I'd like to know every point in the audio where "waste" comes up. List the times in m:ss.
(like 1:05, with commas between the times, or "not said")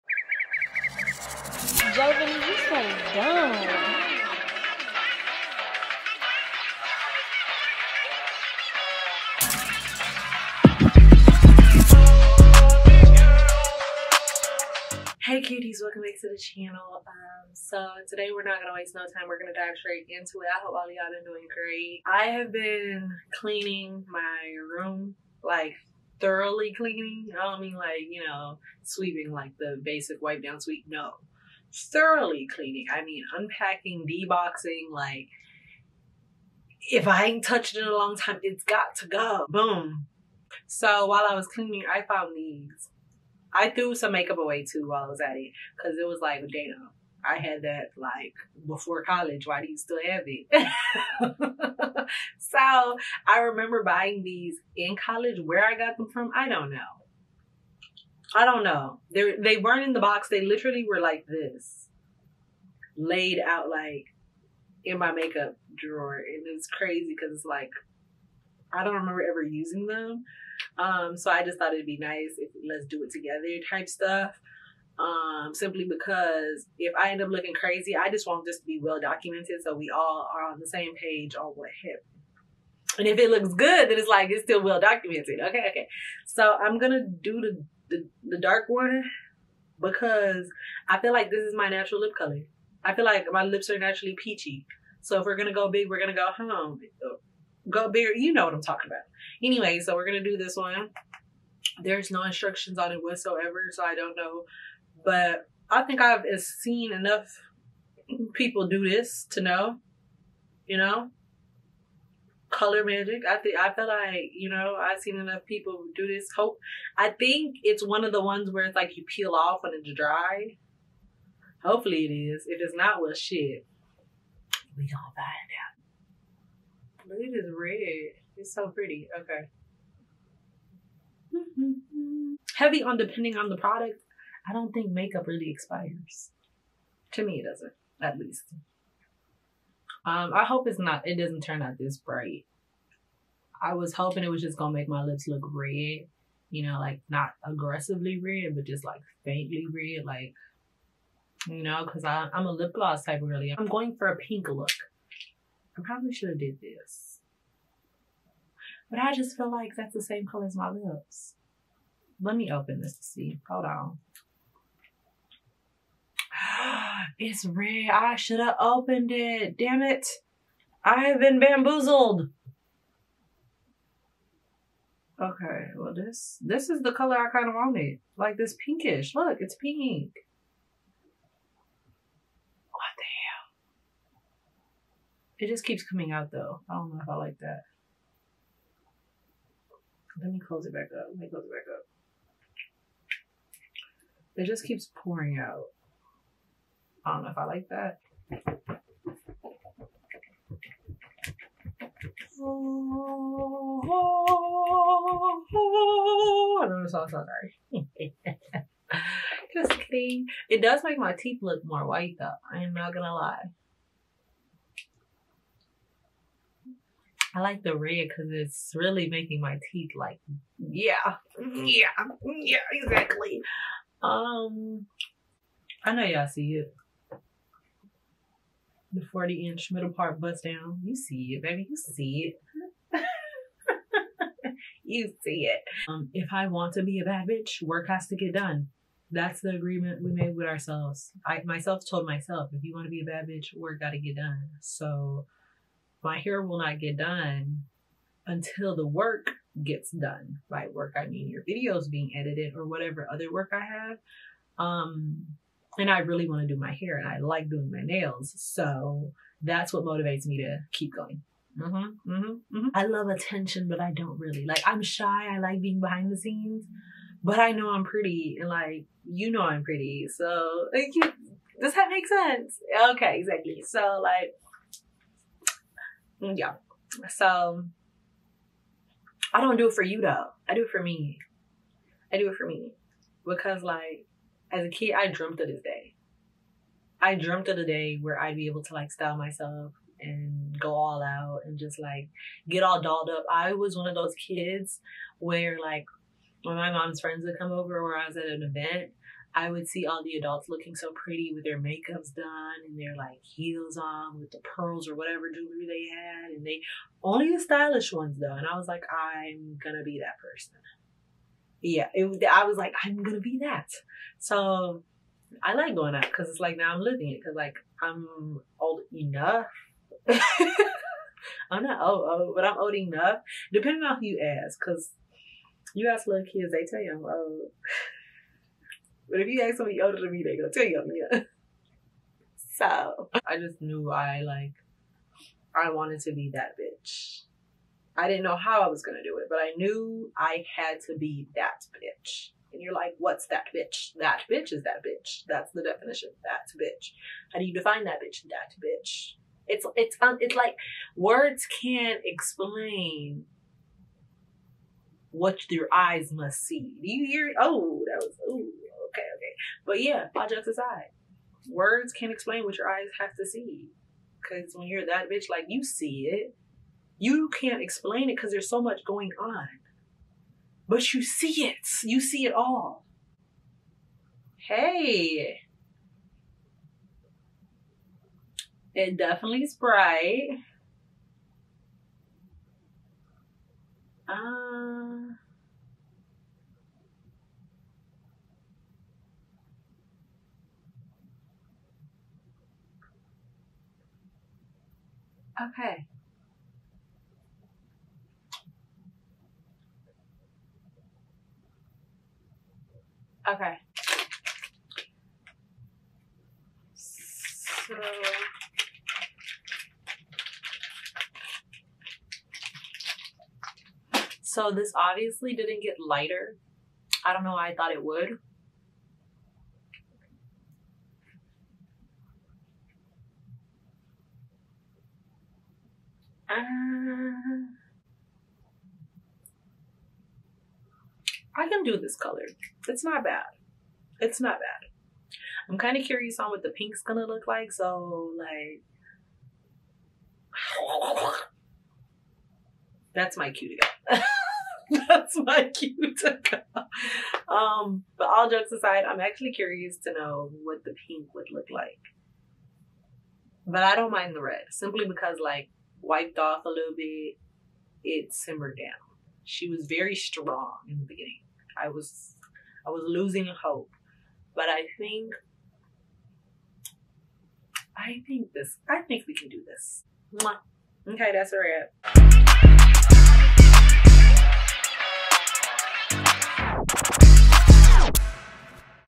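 0:18.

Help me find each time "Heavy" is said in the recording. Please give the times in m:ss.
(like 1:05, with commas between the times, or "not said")
2:12.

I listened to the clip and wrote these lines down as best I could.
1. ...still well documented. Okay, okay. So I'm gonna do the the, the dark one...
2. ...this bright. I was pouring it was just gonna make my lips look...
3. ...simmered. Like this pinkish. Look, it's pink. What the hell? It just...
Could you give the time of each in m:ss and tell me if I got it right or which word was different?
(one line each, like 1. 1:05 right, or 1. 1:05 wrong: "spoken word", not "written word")
1. 1:24 right
2. 2:21 wrong: "hoping", not "pouring"
3. 2:57 wrong: "wanted", not "simmered".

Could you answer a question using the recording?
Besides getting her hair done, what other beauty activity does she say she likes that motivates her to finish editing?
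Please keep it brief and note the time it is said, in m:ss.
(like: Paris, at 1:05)
doing my nails, at 4:17.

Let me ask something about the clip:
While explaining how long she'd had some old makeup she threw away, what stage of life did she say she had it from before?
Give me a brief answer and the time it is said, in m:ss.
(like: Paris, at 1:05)
before college, at 0:48.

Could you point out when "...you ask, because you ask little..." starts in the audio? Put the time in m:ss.
5:24.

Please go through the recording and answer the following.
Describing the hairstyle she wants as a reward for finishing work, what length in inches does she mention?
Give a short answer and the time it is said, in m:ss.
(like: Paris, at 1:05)
40 inch, at 3:49.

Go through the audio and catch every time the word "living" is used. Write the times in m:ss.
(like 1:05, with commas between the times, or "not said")
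5:16.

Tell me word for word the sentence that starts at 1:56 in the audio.
Hope I think it's one of the ones where it's like you peel off and it's dry.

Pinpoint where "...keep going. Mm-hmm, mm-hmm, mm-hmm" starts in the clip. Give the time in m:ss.
4:20.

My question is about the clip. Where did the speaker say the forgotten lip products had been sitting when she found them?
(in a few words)
makeup drawer.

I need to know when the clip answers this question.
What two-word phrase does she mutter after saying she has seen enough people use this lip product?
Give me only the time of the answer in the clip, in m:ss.
1:52.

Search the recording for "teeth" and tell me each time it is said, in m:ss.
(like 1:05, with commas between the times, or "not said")
3:31, 3:39.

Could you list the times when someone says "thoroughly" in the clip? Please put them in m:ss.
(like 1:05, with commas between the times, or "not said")
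0:26, 0:31.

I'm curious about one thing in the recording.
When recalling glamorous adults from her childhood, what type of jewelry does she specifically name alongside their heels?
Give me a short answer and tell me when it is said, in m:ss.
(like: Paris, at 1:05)
pearls, at 5:04.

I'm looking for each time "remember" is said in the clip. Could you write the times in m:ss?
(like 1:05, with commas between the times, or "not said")
0:53, 1:08.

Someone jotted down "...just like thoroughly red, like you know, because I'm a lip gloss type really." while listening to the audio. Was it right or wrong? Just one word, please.
wrong.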